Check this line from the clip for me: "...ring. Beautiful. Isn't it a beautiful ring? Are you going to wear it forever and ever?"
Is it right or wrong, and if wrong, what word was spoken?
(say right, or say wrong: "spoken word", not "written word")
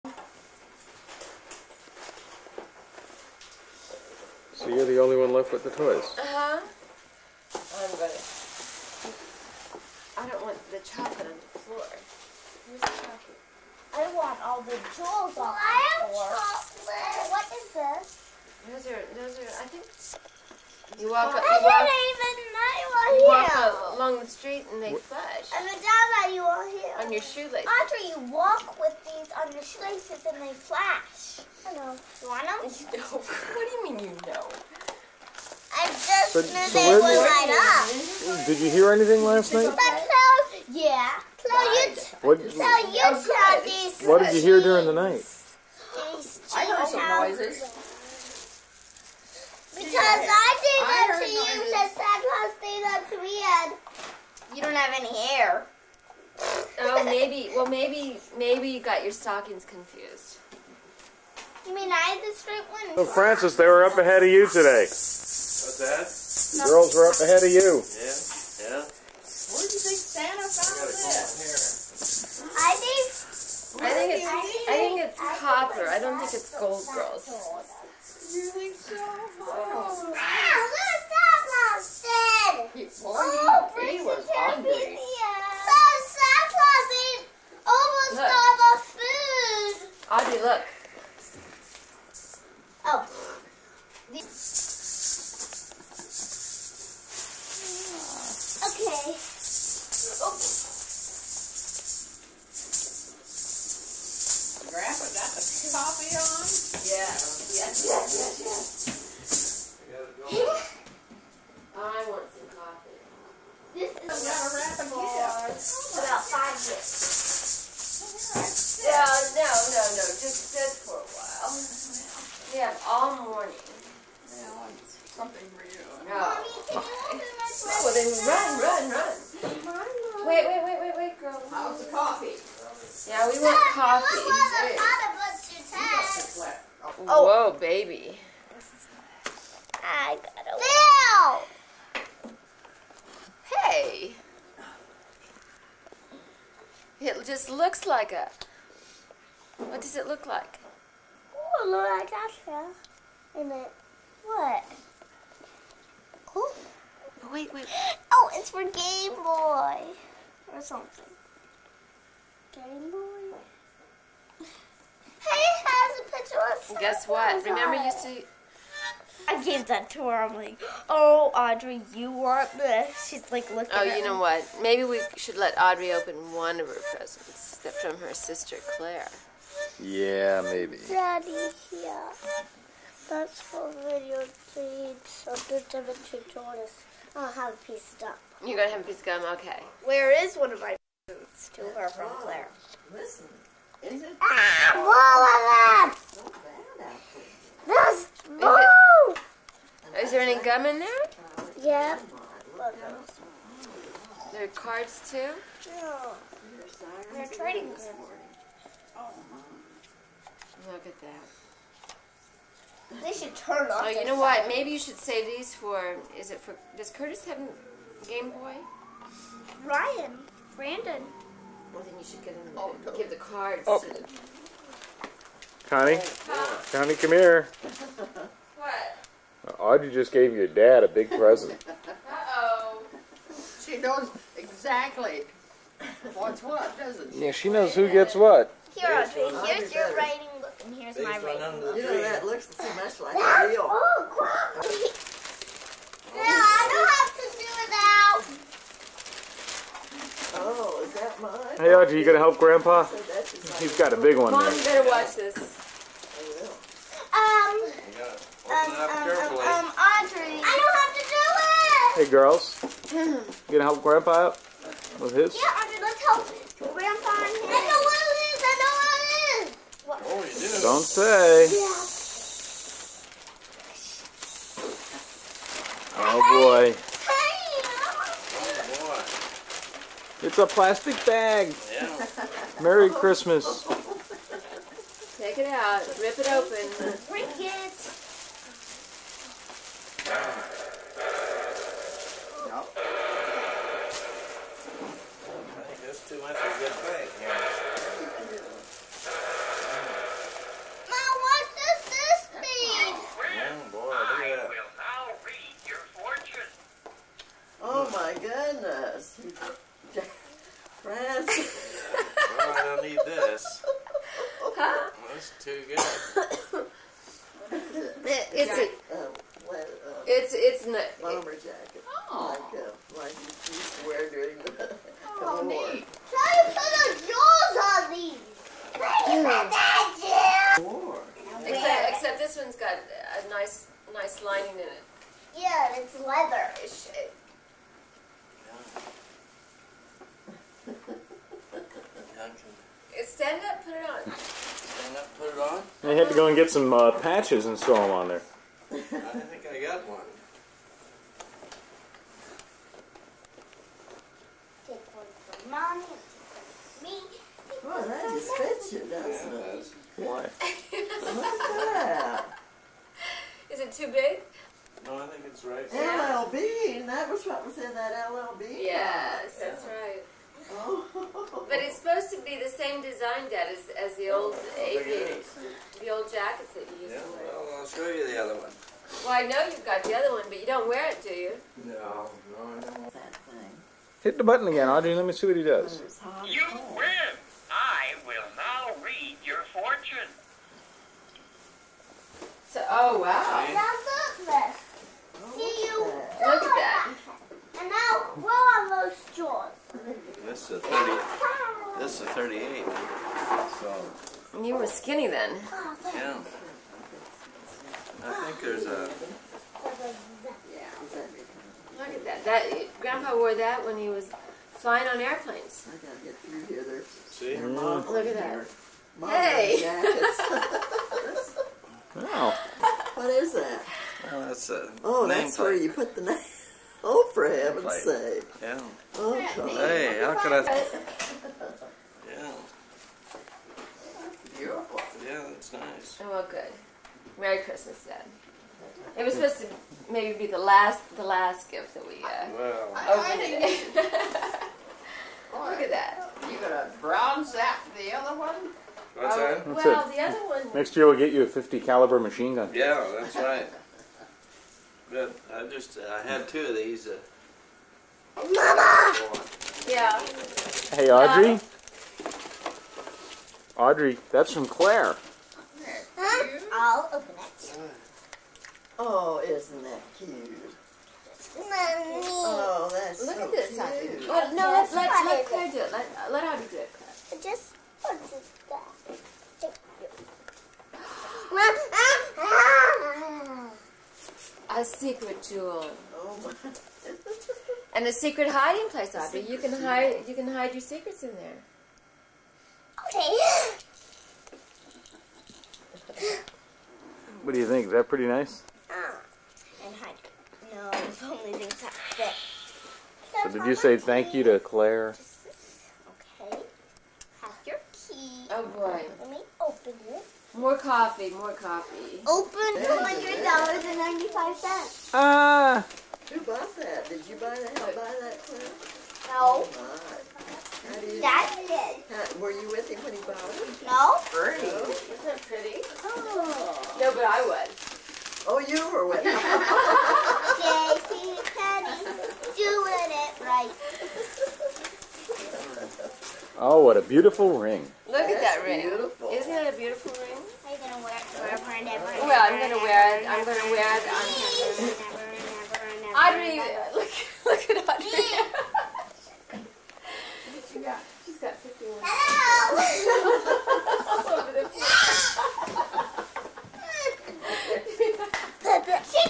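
right.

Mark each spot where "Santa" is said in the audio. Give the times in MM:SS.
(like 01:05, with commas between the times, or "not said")
00:51, 01:10, 01:27.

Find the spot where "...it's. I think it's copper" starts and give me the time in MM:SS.
01:14.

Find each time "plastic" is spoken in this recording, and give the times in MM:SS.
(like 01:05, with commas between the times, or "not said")
04:40.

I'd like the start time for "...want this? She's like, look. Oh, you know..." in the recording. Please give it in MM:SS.
02:52.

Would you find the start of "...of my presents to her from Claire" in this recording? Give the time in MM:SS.
03:10.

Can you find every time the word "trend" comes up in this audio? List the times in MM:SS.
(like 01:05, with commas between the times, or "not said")
not said.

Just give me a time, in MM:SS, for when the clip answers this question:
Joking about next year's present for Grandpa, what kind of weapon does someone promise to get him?
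07:31.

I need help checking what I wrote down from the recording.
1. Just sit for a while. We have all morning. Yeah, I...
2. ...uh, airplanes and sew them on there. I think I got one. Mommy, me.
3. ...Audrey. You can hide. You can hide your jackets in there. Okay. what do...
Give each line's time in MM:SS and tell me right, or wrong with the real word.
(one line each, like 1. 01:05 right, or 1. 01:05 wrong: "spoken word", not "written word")
1. 02:00 right
2. 05:46 wrong: "patches", not "airplanes"
3. 08:08 wrong: "secrets", not "jackets".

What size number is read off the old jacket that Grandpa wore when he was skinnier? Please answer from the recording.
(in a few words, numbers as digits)
38.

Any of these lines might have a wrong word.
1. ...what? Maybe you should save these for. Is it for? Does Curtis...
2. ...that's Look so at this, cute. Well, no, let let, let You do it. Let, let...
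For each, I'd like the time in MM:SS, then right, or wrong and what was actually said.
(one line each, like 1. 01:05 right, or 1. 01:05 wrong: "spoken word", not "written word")
1. 03:34 right
2. 07:52 wrong: "Claire", not "You".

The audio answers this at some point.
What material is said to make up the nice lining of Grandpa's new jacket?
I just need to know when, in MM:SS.
05:35.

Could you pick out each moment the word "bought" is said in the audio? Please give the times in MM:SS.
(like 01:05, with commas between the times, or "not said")
08:36, 08:43.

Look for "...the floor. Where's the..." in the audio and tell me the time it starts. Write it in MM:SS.
00:11.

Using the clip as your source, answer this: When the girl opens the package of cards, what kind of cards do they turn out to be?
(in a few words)
Trading cards.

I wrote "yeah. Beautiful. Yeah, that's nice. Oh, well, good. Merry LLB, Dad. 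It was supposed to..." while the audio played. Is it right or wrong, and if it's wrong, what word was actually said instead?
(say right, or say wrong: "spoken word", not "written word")
wrong: "Christmas", not "LLB".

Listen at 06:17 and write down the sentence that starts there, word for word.
Well, I'll show you the other one.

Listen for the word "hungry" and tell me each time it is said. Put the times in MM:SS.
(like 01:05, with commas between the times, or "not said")
01:24.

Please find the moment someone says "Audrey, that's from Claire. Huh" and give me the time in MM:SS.
07:43.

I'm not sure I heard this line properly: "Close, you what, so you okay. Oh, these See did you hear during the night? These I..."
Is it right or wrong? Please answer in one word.
wrong.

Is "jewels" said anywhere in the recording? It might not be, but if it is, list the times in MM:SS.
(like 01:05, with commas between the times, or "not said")
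00:14, 08:05.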